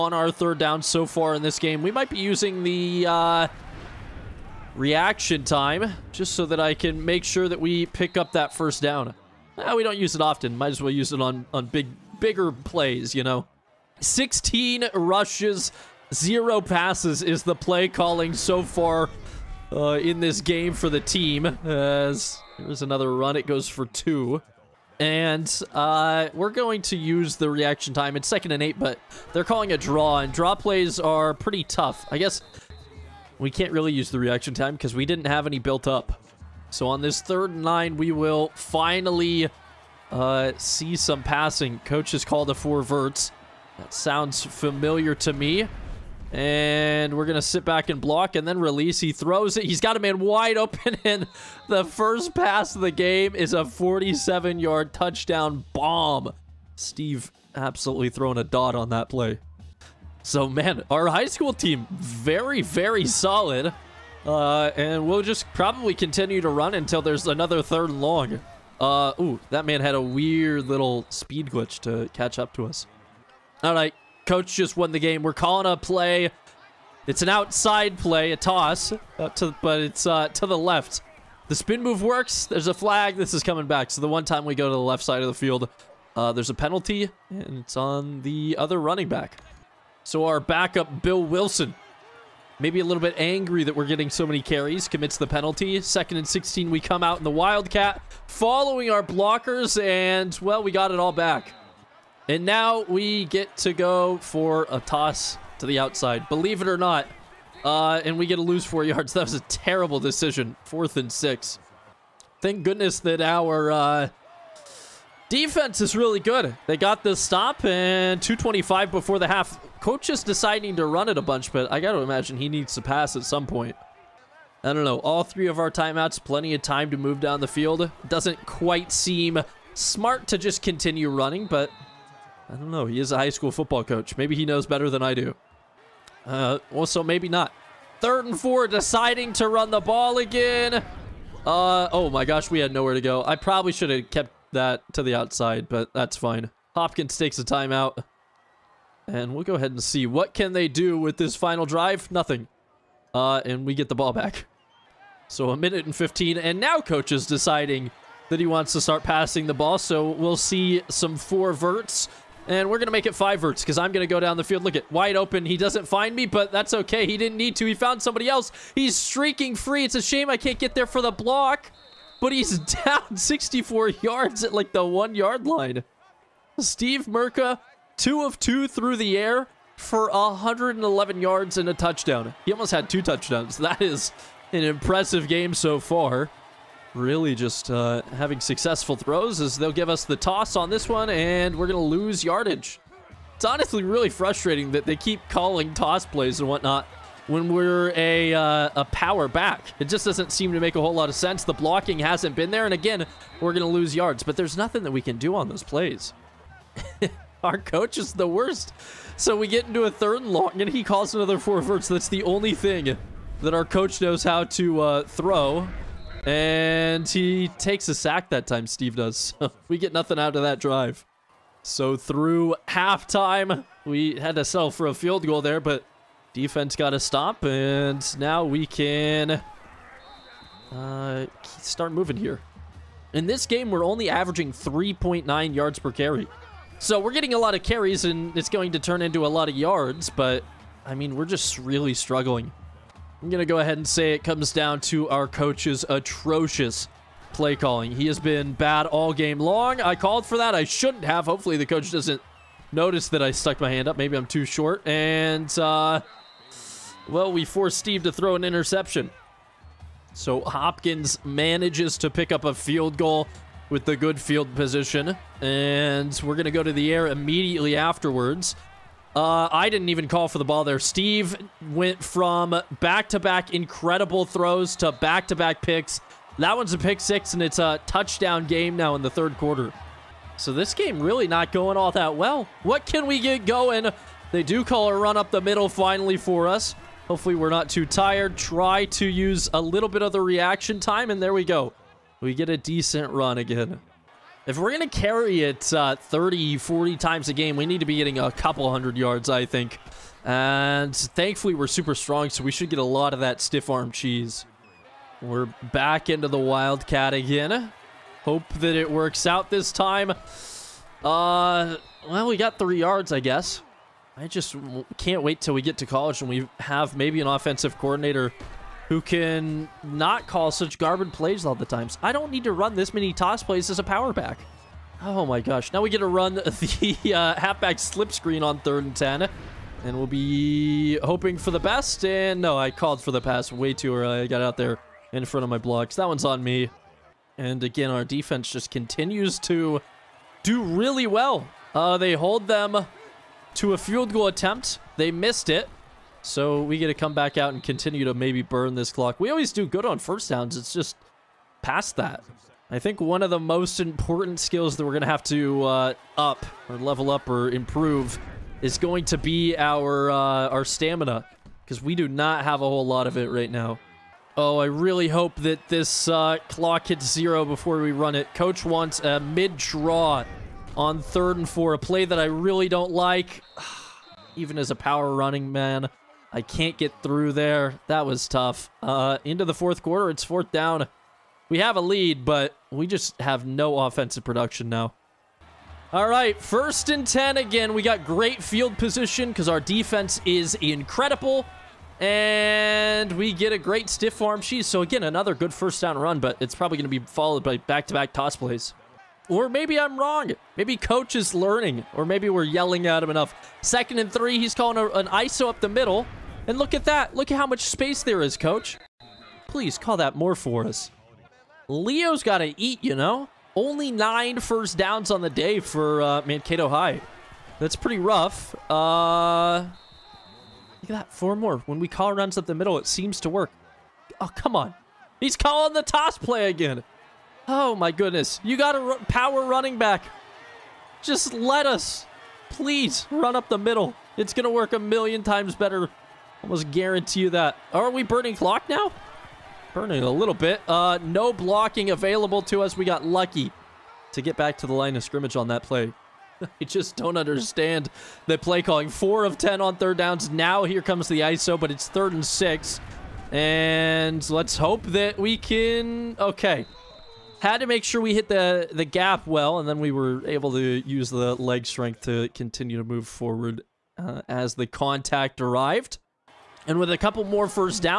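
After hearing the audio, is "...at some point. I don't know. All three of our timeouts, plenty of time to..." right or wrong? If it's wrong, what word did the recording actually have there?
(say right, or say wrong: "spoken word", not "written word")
right.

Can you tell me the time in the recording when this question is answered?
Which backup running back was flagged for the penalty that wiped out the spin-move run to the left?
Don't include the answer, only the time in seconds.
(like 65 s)
91 s.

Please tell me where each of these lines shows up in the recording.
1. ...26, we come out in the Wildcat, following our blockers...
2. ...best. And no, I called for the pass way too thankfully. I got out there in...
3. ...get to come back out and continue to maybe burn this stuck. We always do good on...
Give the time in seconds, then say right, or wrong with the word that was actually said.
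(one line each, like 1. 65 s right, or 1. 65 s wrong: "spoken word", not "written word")
1. 96 s wrong: "16", not "26"
2. 331 s wrong: "early", not "thankfully"
3. 346 s wrong: "clock", not "stuck".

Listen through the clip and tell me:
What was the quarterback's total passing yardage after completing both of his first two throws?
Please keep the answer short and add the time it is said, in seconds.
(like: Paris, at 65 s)
111 yards, at 180 s.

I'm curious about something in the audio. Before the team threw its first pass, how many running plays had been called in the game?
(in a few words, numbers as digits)
16.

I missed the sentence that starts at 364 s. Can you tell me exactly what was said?
Oh, I really hope that this uh, clock hits zero before we run it.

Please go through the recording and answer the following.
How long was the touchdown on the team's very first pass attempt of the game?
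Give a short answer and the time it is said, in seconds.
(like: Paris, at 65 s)
47 yards, at 53 s.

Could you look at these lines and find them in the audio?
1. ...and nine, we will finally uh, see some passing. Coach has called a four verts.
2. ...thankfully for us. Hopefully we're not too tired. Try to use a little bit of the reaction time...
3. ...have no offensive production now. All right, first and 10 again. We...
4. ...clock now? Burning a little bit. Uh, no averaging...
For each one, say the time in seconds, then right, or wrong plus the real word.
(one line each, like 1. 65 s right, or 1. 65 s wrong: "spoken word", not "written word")
1. 37 s right
2. 285 s wrong: "finally", not "thankfully"
3. 383 s right
4. 438 s wrong: "blocking", not "averaging".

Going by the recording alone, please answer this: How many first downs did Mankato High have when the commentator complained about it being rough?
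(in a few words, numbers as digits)
9.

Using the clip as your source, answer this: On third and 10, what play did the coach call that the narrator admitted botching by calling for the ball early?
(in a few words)
Halfback slip screen.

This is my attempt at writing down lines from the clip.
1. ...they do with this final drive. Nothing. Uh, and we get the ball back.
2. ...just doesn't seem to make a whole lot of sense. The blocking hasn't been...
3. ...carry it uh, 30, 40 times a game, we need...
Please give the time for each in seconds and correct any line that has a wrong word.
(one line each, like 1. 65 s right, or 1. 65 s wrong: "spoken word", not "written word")
1. 150 s right
2. 199 s right
3. 294 s right.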